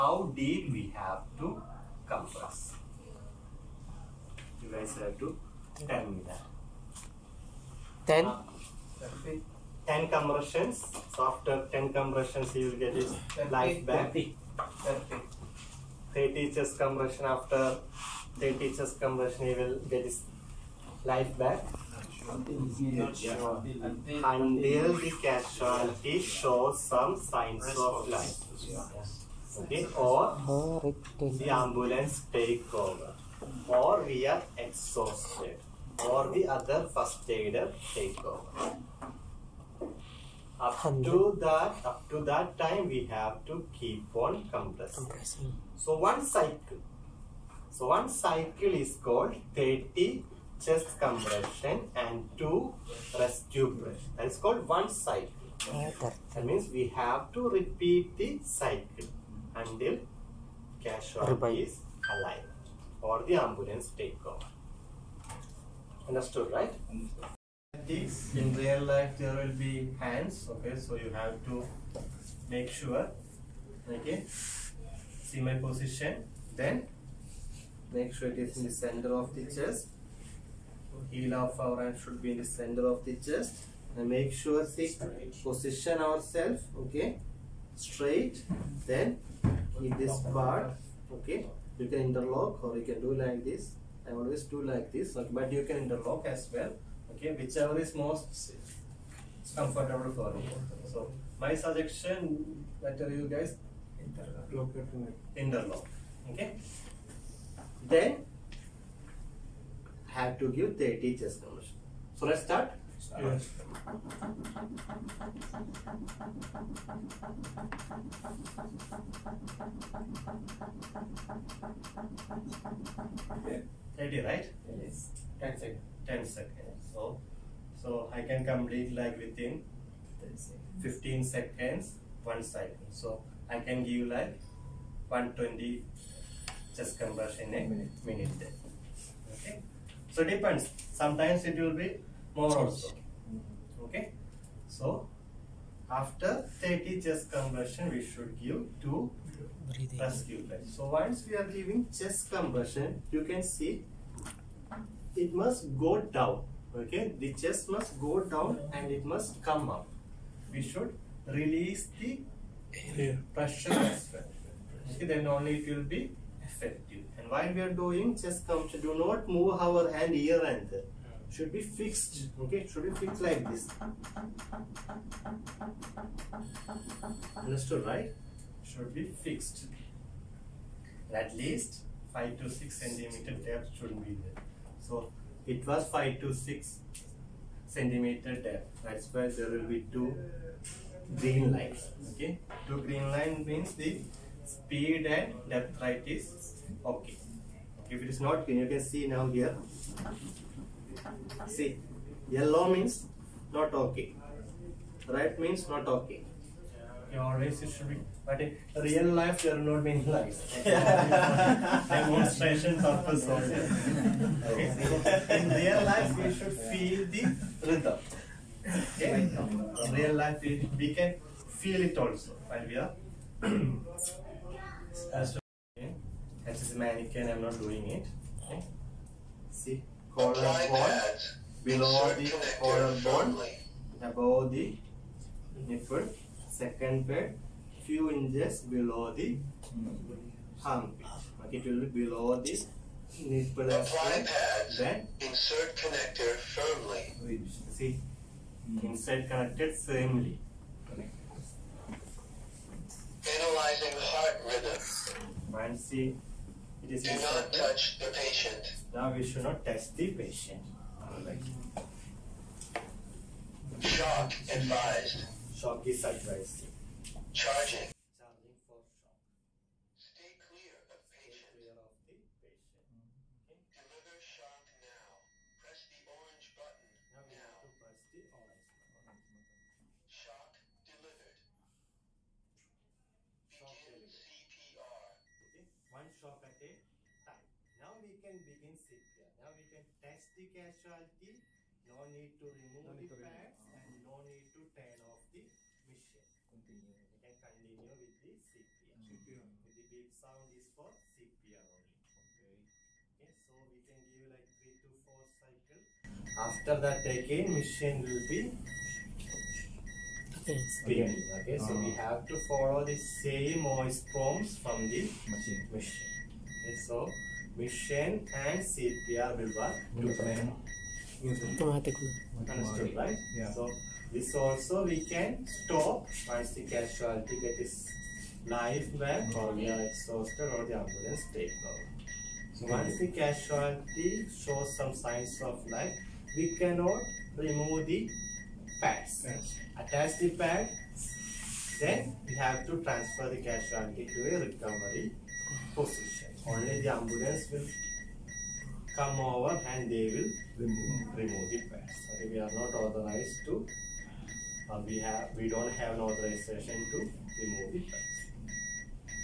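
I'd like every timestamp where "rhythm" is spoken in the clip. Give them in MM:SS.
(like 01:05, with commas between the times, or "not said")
03:37, 04:14.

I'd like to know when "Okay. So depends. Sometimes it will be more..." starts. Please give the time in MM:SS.
02:19.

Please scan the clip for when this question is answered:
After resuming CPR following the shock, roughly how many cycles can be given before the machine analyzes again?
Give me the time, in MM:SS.
05:04.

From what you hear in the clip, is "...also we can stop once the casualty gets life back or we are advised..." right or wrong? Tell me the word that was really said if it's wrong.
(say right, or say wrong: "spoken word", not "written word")
wrong: "exhausted", not "advised".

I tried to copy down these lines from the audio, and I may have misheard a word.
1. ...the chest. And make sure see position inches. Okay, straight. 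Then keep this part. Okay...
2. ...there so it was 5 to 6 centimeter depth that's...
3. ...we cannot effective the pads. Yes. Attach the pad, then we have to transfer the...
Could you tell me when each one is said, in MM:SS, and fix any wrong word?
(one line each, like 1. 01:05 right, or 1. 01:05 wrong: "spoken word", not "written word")
1. 01:23 wrong: "ourselves", not "inches"
2. 03:04 right
3. 05:36 wrong: "remove", not "effective".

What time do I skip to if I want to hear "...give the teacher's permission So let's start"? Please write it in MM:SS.
01:50.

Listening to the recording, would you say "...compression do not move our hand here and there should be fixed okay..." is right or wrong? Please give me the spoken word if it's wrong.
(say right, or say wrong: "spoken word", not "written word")
right.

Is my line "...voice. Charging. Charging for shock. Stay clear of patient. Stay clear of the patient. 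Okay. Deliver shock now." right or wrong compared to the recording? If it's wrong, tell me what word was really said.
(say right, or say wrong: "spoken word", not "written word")
wrong: "price", not "voice".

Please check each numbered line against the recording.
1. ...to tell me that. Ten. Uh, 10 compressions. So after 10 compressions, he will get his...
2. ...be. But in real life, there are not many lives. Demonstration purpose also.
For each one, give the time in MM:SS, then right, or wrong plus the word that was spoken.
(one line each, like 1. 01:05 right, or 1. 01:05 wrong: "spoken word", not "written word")
1. 00:05 right
2. 03:27 right.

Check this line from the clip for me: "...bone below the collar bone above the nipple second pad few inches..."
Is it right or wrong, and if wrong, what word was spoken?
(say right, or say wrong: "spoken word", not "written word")
right.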